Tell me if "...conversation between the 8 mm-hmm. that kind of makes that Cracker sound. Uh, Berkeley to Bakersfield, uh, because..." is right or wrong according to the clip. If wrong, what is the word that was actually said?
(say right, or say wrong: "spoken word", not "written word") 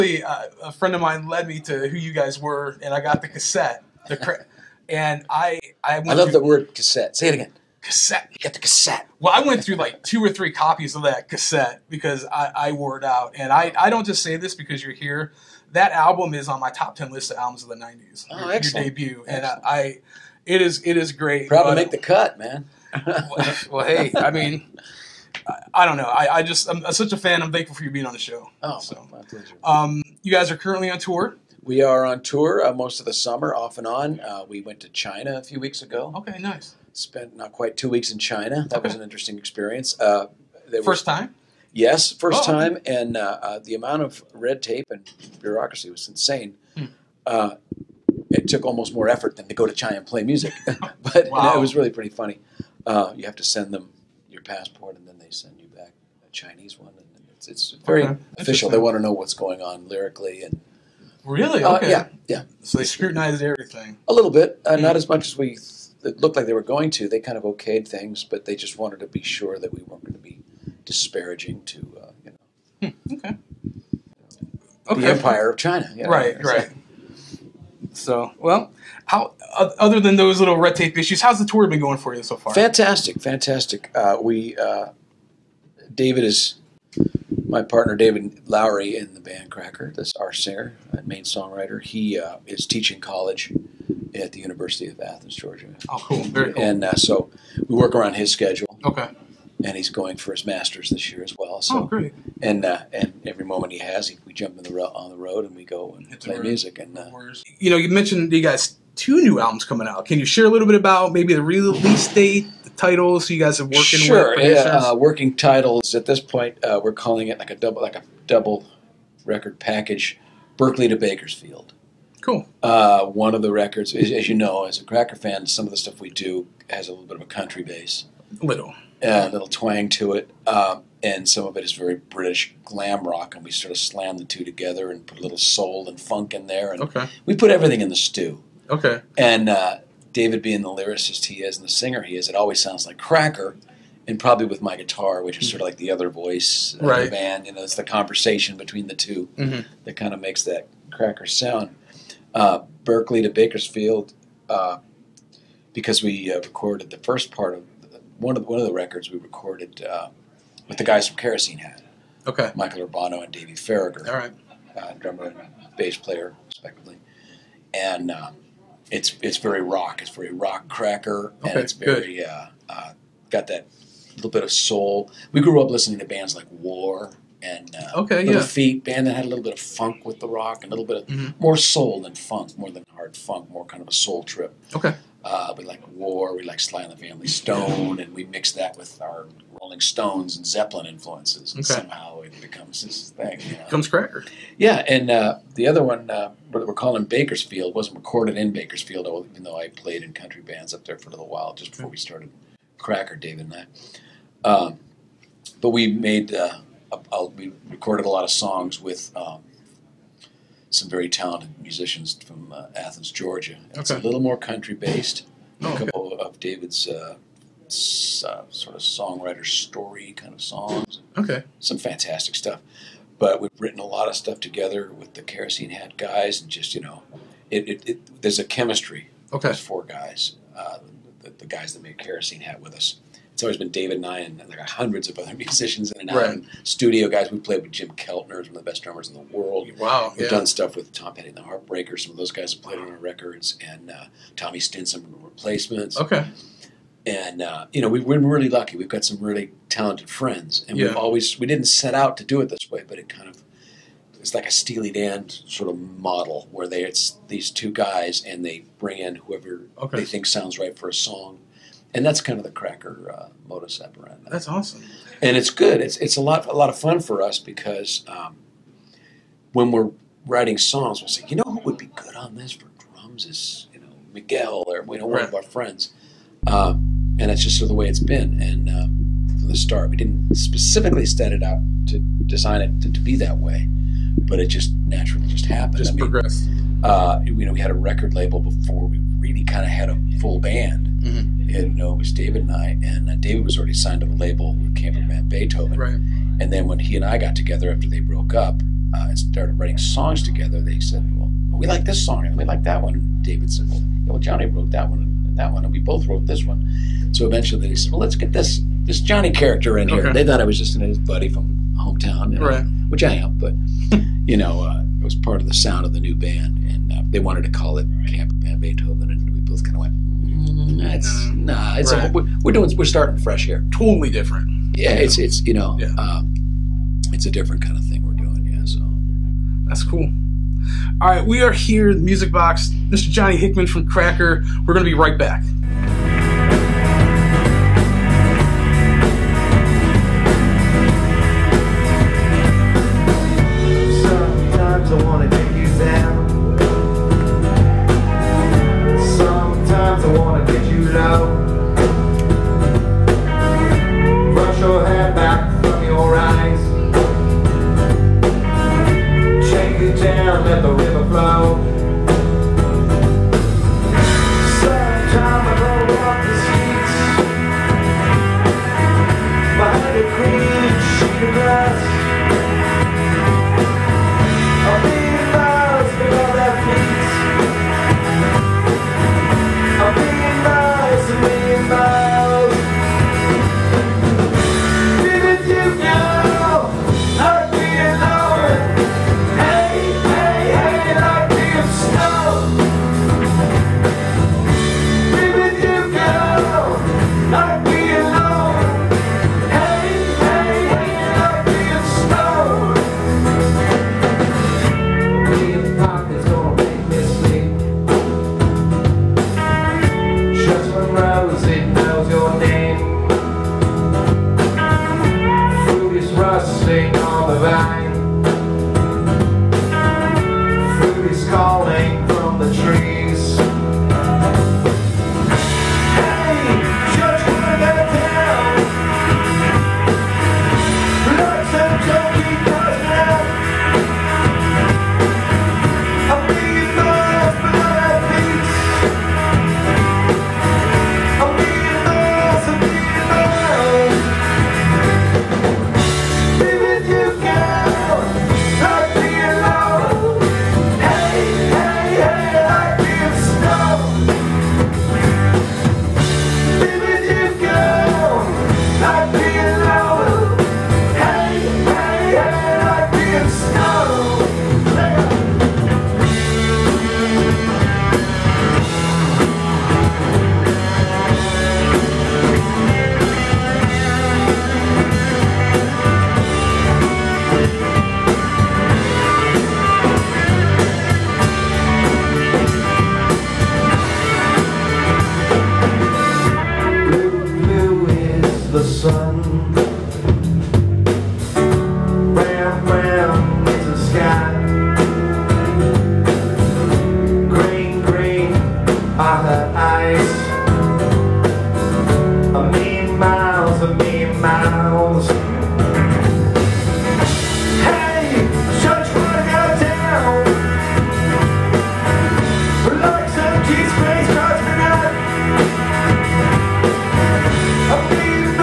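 wrong: "2", not "8".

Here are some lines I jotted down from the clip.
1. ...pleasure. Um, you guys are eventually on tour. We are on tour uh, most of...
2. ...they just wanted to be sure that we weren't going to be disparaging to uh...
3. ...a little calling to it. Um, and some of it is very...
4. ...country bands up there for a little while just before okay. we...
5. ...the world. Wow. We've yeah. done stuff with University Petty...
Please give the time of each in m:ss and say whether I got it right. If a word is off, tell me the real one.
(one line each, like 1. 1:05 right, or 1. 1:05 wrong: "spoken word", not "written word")
1. 0:29 wrong: "currently", not "eventually"
2. 1:08 right
3. 2:09 wrong: "twang", not "calling"
4. 3:20 right
5. 3:59 wrong: "Tom", not "University".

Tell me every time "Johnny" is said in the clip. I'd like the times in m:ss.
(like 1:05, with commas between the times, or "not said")
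5:04, 5:08, 5:33.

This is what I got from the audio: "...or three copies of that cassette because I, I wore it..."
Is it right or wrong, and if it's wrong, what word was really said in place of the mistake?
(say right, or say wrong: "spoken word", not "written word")
right.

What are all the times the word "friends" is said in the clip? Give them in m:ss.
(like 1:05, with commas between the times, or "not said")
0:00, 4:10, 4:35.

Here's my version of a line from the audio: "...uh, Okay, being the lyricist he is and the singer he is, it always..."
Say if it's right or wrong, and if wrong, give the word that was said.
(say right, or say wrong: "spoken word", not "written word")
wrong: "David", not "Okay".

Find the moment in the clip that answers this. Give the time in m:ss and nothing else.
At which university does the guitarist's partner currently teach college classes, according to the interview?
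1:34.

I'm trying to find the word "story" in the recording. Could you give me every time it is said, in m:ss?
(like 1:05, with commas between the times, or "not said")
3:39.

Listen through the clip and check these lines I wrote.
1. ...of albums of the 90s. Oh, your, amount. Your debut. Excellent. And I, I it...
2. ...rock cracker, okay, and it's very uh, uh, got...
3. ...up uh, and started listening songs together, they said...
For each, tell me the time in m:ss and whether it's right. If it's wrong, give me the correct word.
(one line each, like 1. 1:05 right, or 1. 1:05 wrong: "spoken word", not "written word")
1. 0:17 wrong: "excellent", not "amount"
2. 2:50 right
3. 4:58 wrong: "writing", not "listening".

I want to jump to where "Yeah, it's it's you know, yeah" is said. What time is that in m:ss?
5:24.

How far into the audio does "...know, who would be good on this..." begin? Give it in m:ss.
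4:31.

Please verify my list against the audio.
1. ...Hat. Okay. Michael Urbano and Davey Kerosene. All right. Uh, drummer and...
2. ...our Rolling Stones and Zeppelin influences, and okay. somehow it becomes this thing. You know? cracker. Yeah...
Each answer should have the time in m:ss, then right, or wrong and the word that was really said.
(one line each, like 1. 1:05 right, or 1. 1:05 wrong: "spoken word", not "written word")
1. 2:41 wrong: "Faragher", not "Kerosene"
2. 3:09 right.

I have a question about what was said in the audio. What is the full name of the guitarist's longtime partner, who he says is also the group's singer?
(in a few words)
David Lowery.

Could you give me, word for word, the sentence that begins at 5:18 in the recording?
Camper Band Beethoven, and we both kind of went, mm-hmm.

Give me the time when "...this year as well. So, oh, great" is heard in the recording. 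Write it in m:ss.
1:40.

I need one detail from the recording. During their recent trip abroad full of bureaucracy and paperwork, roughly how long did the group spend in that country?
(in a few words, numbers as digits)
not quite 2 weeks.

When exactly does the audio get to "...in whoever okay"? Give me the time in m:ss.
4:18.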